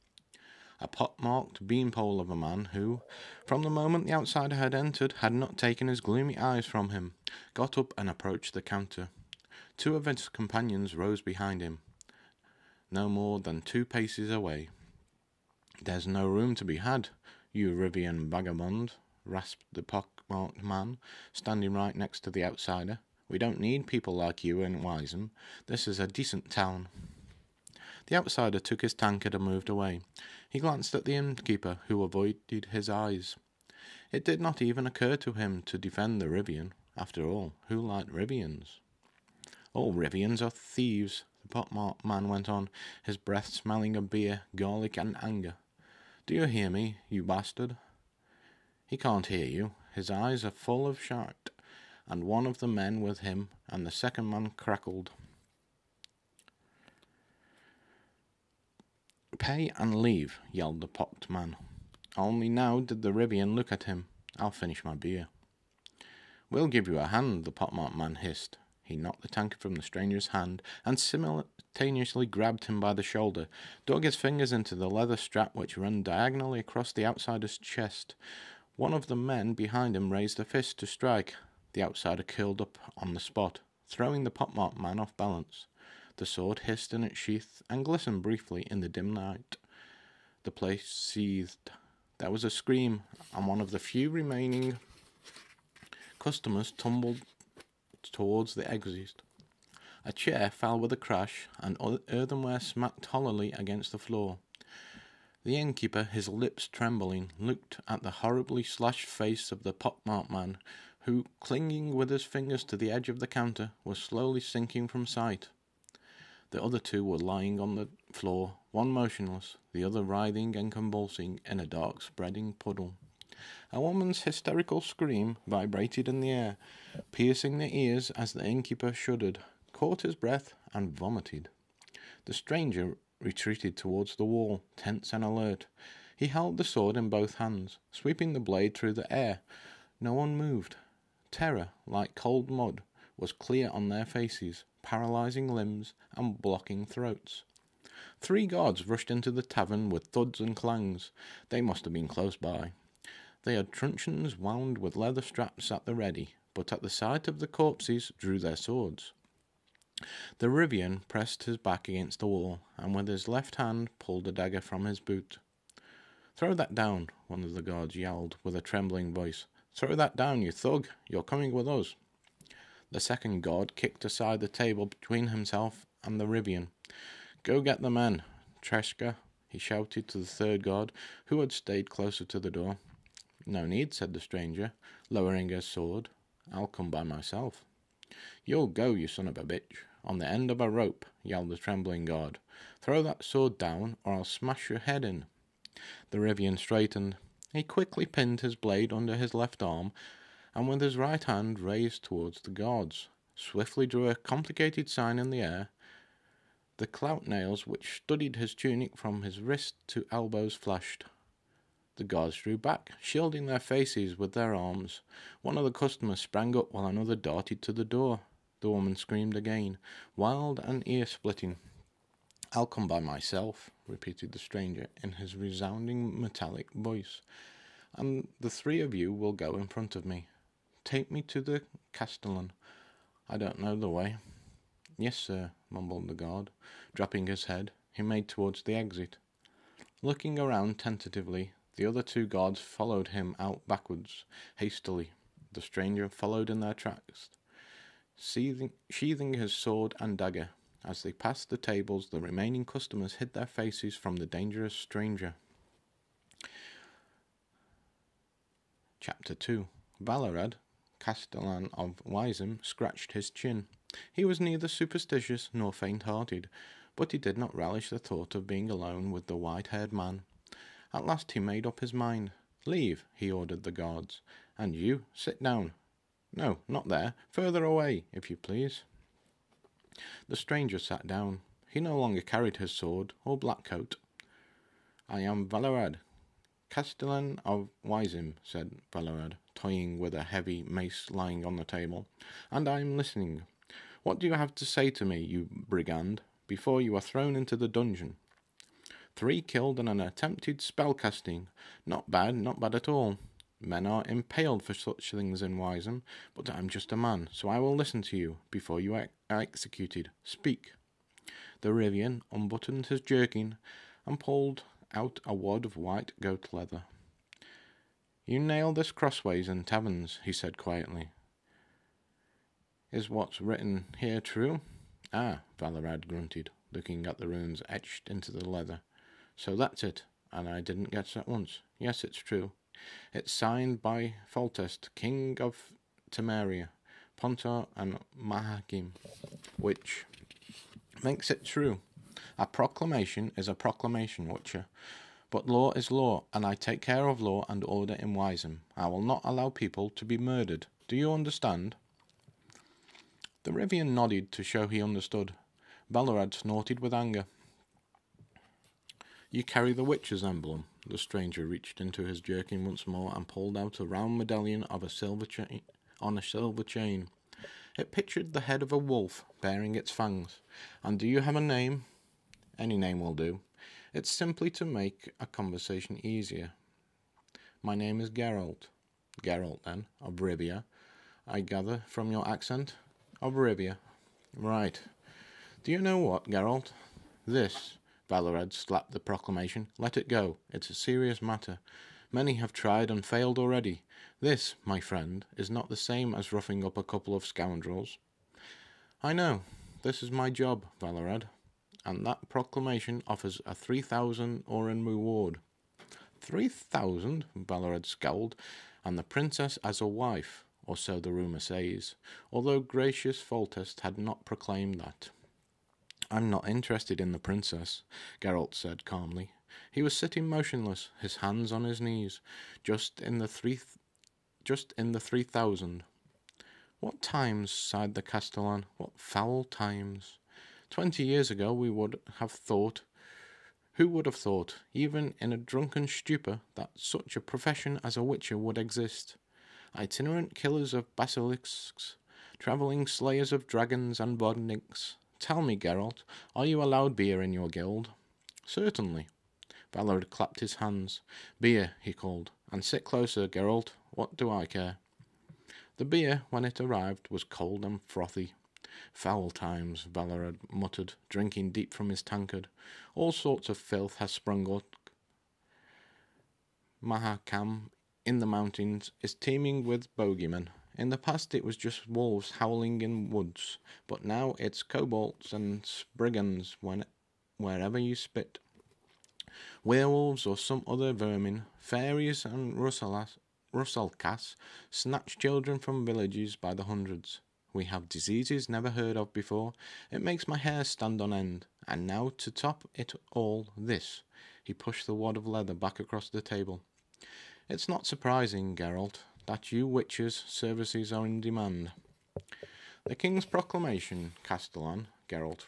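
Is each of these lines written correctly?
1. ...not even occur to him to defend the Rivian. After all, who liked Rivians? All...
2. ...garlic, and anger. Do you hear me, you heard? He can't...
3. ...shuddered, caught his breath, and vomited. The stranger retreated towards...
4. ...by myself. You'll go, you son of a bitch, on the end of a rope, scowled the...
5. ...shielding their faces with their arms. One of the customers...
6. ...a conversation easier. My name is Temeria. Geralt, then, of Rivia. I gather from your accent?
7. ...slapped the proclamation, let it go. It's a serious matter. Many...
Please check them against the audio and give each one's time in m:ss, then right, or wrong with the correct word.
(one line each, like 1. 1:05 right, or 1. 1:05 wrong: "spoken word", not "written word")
1. 0:34 right
2. 0:44 wrong: "bastard", not "heard"
3. 2:08 right
4. 3:06 wrong: "yelled", not "scowled"
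5. 3:32 right
6. 6:15 wrong: "Geralt", not "Temeria"
7. 6:28 right.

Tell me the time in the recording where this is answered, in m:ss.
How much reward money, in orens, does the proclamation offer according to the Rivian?
6:43.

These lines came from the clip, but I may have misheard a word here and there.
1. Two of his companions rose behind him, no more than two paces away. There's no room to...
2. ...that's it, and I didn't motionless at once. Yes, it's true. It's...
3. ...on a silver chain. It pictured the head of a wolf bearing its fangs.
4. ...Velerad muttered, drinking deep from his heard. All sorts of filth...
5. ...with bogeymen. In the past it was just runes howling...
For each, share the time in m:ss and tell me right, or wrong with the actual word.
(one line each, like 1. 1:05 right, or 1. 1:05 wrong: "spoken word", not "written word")
1. 0:09 right
2. 5:29 wrong: "guess", not "motionless"
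3. 6:05 right
4. 7:39 wrong: "tankard", not "heard"
5. 7:49 wrong: "wolves", not "runes".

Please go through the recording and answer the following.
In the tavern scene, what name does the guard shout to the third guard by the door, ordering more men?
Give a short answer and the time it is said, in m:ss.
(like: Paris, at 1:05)
Treska, at 2:58.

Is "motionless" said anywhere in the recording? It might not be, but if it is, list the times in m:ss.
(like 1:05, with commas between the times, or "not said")
1:58, 7:00.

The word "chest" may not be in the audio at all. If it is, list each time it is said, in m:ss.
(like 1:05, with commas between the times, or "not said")
1:17.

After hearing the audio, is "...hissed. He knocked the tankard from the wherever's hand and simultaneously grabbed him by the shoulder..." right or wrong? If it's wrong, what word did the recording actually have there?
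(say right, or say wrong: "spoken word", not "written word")
wrong: "stranger", not "wherever".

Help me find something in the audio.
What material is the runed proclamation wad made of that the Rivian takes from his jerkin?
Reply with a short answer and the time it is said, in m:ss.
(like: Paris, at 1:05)
white goat leather, at 5:15.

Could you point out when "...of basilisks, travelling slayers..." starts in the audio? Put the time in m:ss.
7:20.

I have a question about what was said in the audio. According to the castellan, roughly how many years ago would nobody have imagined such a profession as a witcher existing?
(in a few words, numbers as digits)
20.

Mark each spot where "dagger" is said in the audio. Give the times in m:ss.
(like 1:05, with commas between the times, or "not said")
2:44, 4:10.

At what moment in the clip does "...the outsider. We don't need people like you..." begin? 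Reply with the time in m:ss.
0:22.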